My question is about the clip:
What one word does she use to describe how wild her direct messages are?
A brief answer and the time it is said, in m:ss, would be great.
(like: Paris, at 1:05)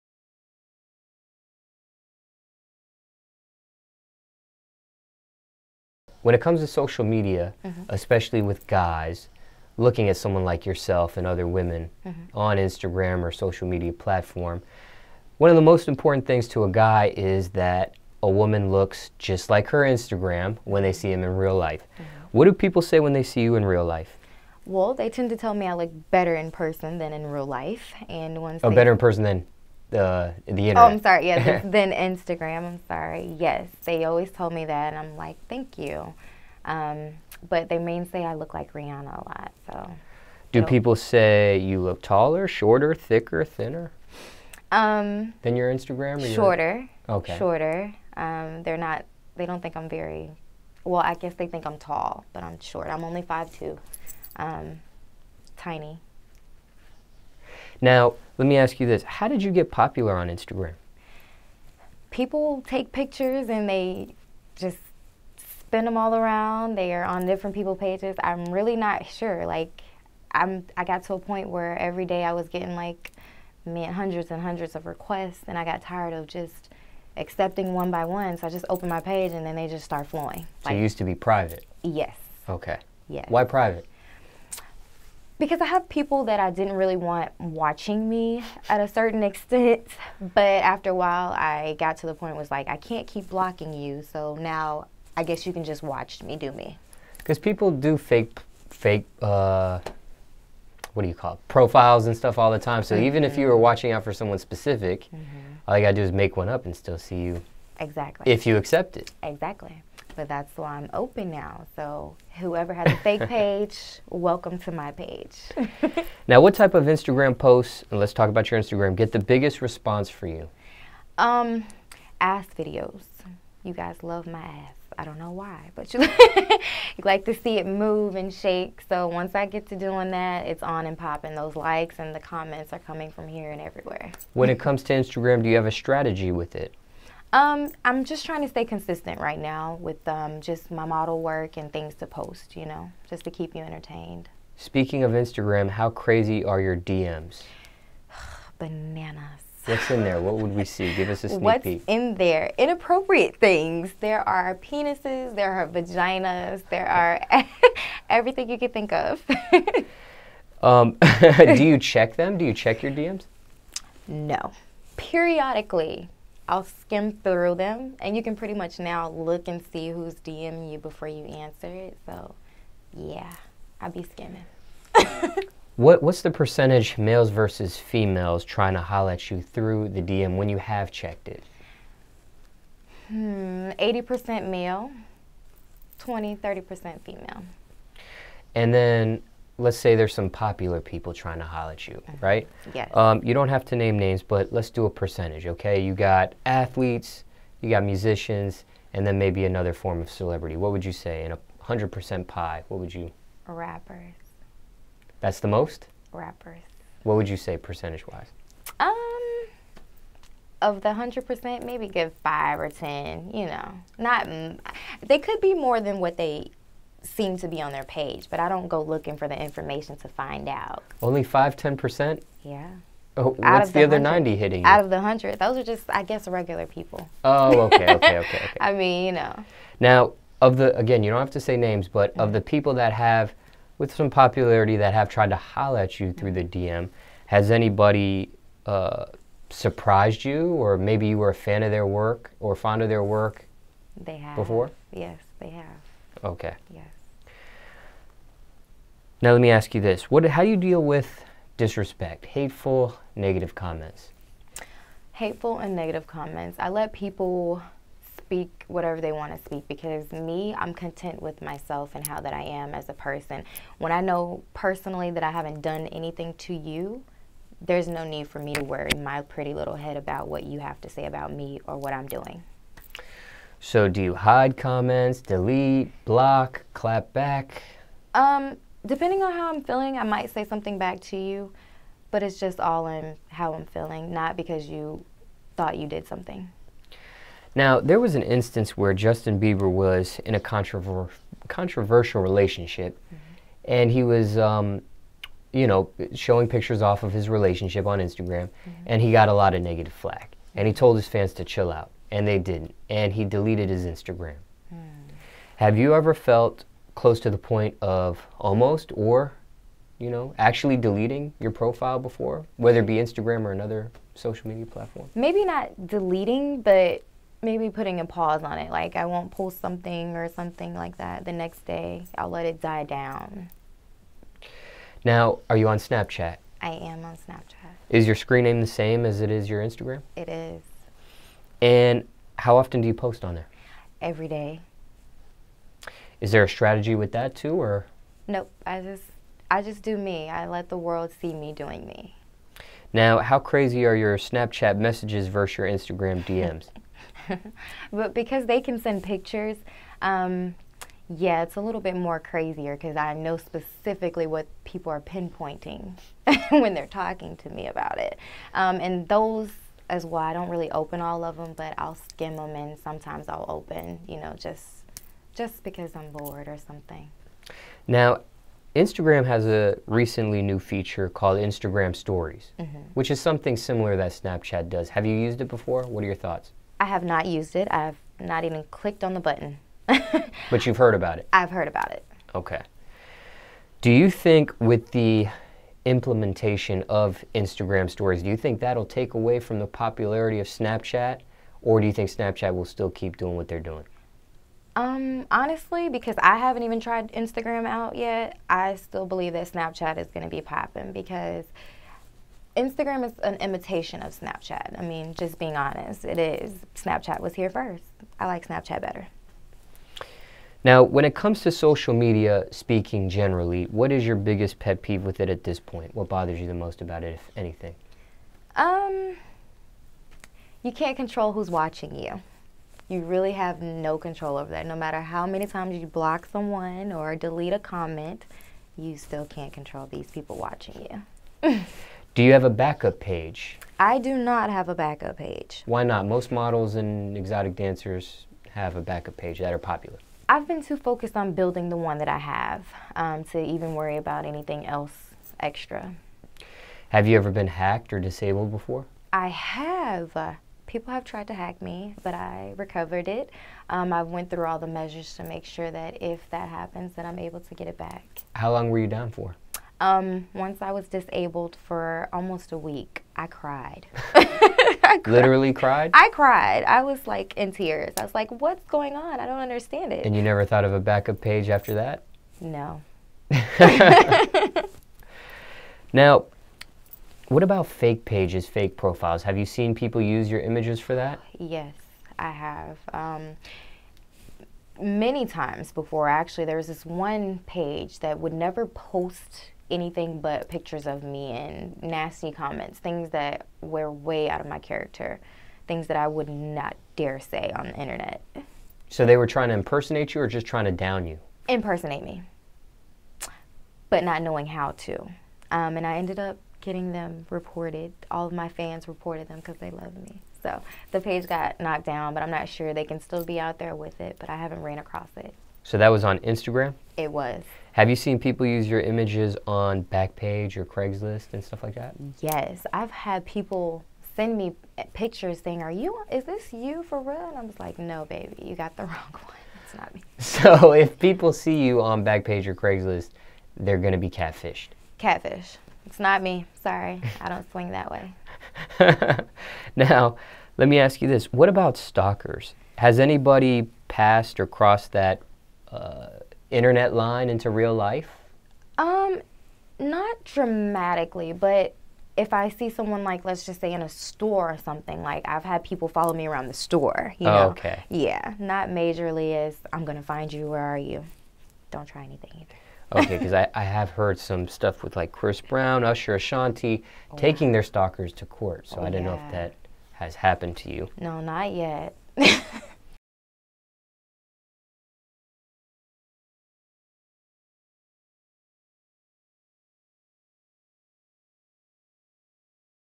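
Bananas, at 2:28.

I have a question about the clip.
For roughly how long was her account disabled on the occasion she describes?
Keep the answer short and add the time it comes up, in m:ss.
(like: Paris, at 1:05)
Almost a week, at 7:42.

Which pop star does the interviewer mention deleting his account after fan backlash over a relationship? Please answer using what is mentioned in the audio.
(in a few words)
Justin Bieber.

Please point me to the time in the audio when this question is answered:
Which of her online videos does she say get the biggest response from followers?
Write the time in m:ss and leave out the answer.
2:02.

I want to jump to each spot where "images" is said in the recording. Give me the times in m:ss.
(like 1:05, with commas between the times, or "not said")
8:00, 8:38.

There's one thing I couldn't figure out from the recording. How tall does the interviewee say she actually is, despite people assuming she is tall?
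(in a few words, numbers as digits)
5'2".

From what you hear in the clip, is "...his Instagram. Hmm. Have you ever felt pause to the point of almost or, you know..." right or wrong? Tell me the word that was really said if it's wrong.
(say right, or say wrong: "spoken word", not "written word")
wrong: "close", not "pause".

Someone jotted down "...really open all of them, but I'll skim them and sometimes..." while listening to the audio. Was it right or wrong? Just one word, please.
right.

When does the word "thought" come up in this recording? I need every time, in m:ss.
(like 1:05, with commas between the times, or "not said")
4:45, 6:16, 7:50.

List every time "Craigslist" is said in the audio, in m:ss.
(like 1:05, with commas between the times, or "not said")
8:40, 8:52.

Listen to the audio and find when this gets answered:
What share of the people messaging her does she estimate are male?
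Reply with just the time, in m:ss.
3:03.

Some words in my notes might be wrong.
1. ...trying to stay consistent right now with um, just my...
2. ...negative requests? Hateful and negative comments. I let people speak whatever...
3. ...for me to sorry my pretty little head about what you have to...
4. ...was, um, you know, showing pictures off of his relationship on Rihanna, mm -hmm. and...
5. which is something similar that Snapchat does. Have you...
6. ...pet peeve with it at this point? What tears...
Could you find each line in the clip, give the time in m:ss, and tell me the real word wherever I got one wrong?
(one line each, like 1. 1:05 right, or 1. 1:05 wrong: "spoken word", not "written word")
1. 2:18 right
2. 4:13 wrong: "comments", not "requests"
3. 4:28 wrong: "worry", not "sorry"
4. 4:54 wrong: "Instagram", not "Rihanna"
5. 6:12 right
6. 6:54 wrong: "bothers", not "tears".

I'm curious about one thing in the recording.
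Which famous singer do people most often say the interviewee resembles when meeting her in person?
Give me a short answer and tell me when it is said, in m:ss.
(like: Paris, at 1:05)
Rihanna, at 0:38.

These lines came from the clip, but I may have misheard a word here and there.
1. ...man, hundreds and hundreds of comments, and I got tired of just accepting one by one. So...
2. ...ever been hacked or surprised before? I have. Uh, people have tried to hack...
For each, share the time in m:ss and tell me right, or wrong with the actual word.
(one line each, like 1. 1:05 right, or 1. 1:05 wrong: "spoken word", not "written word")
1. 1:13 wrong: "requests", not "comments"
2. 7:27 wrong: "disabled", not "surprised".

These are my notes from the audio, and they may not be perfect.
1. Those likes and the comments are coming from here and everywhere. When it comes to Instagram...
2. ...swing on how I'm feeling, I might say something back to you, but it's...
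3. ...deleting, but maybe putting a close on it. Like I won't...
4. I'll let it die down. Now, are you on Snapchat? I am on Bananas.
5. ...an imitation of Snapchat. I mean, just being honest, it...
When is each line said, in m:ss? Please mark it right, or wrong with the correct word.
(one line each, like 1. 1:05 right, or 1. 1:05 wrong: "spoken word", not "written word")
1. 2:11 right
2. 4:38 wrong: "depending", not "swing"
3. 5:15 wrong: "pause", not "close"
4. 5:22 wrong: "Snapchat", not "Bananas"
5. 6:43 right.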